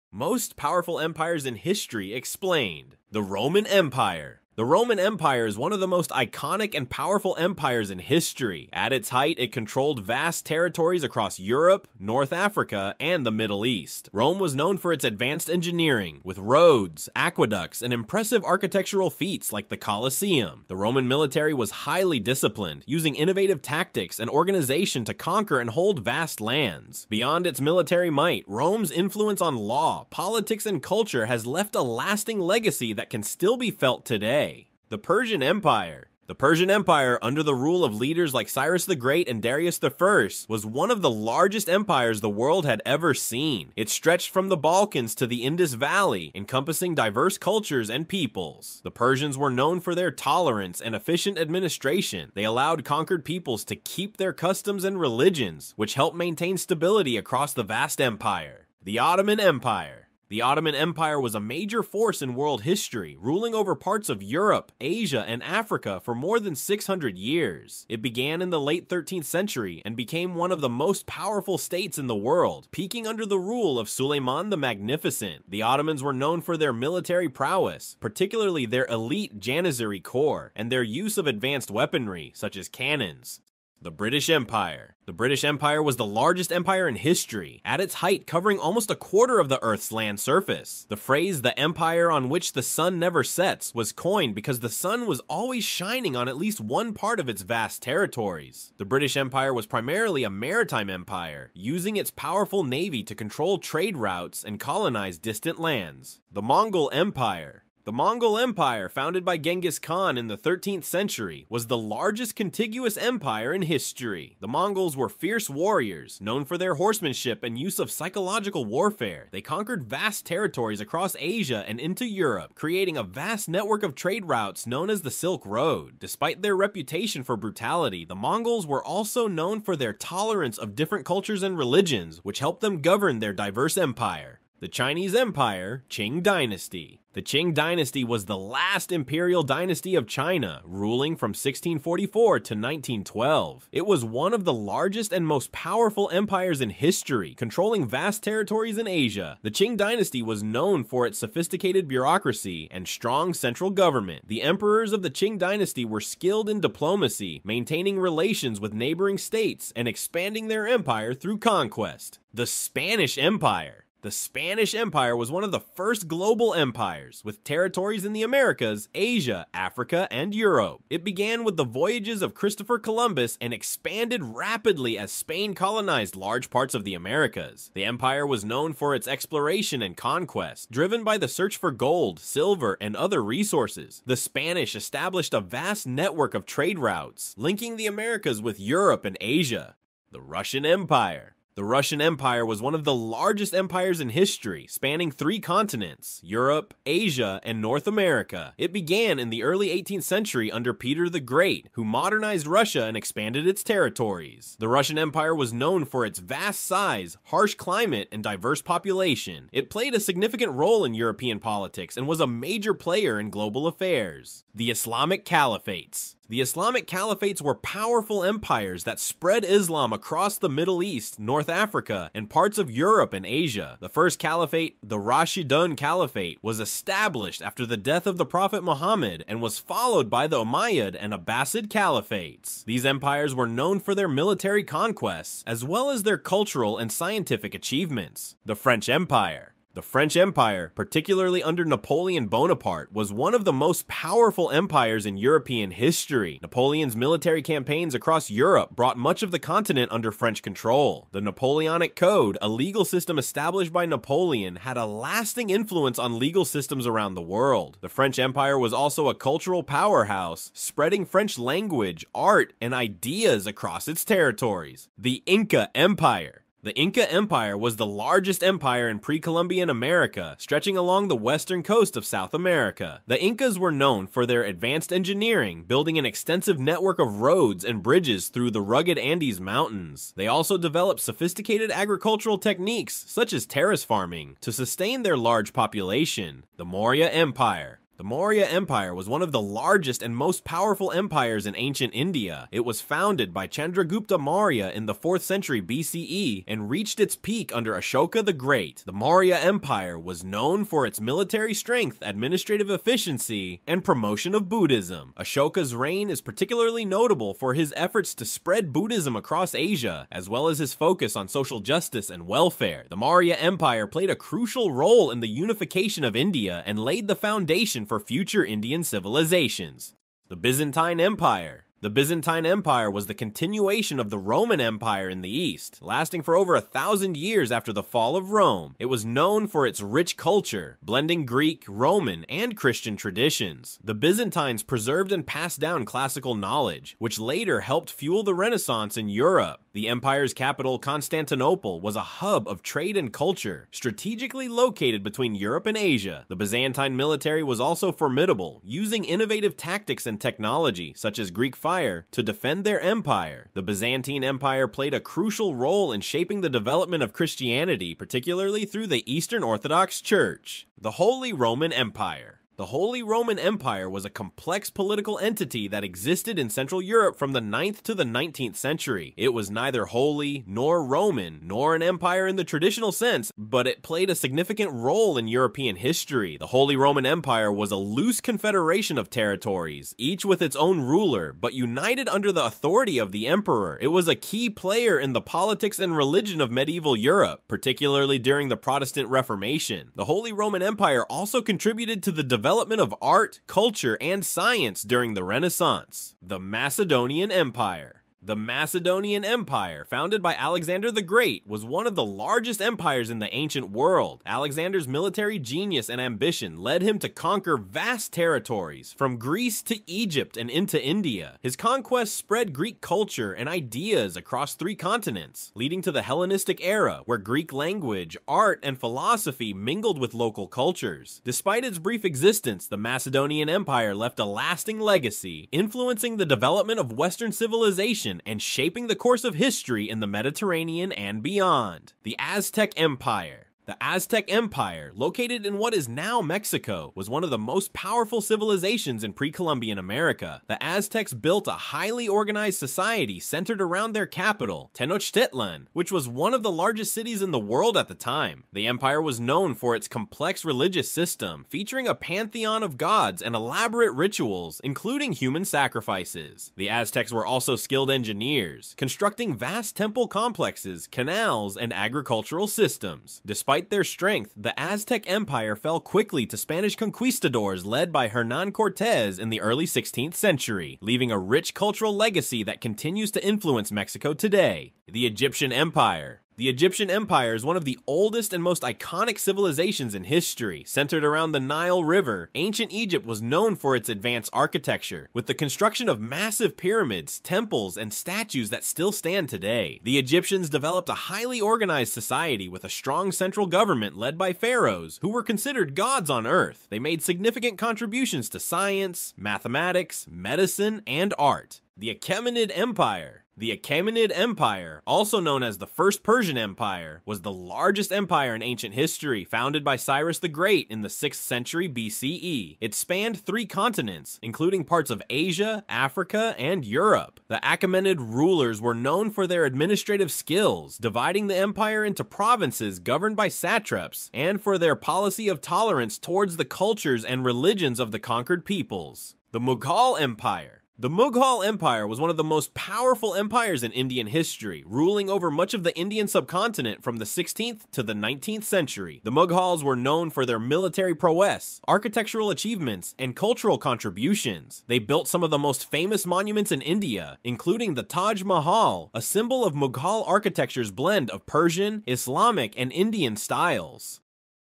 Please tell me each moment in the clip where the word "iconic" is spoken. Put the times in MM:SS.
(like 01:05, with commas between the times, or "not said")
00:06, 07:58.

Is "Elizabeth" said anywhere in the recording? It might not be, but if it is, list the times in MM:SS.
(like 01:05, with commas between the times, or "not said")
not said.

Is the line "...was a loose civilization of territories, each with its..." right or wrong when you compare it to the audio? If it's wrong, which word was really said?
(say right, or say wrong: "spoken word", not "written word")
wrong: "confederation", not "civilization".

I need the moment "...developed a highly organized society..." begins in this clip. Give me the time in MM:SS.
08:10.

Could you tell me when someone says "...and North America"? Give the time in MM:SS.
03:17.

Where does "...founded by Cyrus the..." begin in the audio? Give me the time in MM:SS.
08:29.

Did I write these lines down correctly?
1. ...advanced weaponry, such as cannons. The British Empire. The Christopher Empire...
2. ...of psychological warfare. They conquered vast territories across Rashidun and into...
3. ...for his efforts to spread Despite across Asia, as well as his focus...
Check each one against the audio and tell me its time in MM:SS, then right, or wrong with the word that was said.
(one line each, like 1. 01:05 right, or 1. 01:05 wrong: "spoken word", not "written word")
1. 01:21 wrong: "British", not "Christopher"
2. 01:57 wrong: "Asia", not "Rashidun"
3. 05:07 wrong: "Buddhism", not "Despite".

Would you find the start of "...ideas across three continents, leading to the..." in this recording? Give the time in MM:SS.
06:53.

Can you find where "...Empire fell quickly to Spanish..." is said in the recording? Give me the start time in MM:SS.
07:45.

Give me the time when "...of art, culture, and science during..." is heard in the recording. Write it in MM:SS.
06:32.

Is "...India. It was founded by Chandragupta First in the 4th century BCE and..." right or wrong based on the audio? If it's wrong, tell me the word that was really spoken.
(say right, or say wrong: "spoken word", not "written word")
wrong: "Maurya", not "First".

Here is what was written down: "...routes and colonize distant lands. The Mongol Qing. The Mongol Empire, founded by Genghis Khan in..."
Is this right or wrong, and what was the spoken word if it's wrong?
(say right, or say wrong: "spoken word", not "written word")
wrong: "Empire", not "Qing".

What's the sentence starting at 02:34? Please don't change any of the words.
The emperors of the Qing Dynasty were skilled in diplomacy, maintaining relations with neighboring states, and expanding their empire through conquest.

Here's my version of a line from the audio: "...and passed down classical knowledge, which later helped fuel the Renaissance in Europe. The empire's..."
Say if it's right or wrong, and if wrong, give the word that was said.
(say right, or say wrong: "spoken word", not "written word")
right.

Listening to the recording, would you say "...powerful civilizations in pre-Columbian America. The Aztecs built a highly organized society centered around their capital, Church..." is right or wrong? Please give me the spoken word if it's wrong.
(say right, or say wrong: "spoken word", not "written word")
wrong: "Tenochtitlan", not "Church".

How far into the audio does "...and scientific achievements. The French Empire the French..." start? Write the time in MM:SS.
03:56.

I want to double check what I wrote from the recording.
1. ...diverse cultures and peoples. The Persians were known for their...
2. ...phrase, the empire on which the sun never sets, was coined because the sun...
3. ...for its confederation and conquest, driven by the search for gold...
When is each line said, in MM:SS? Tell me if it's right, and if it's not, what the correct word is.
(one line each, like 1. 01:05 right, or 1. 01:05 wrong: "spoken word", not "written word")
1. 00:46 right
2. 01:30 right
3. 02:58 wrong: "exploration", not "confederation".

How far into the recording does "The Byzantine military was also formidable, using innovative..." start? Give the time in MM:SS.
05:46.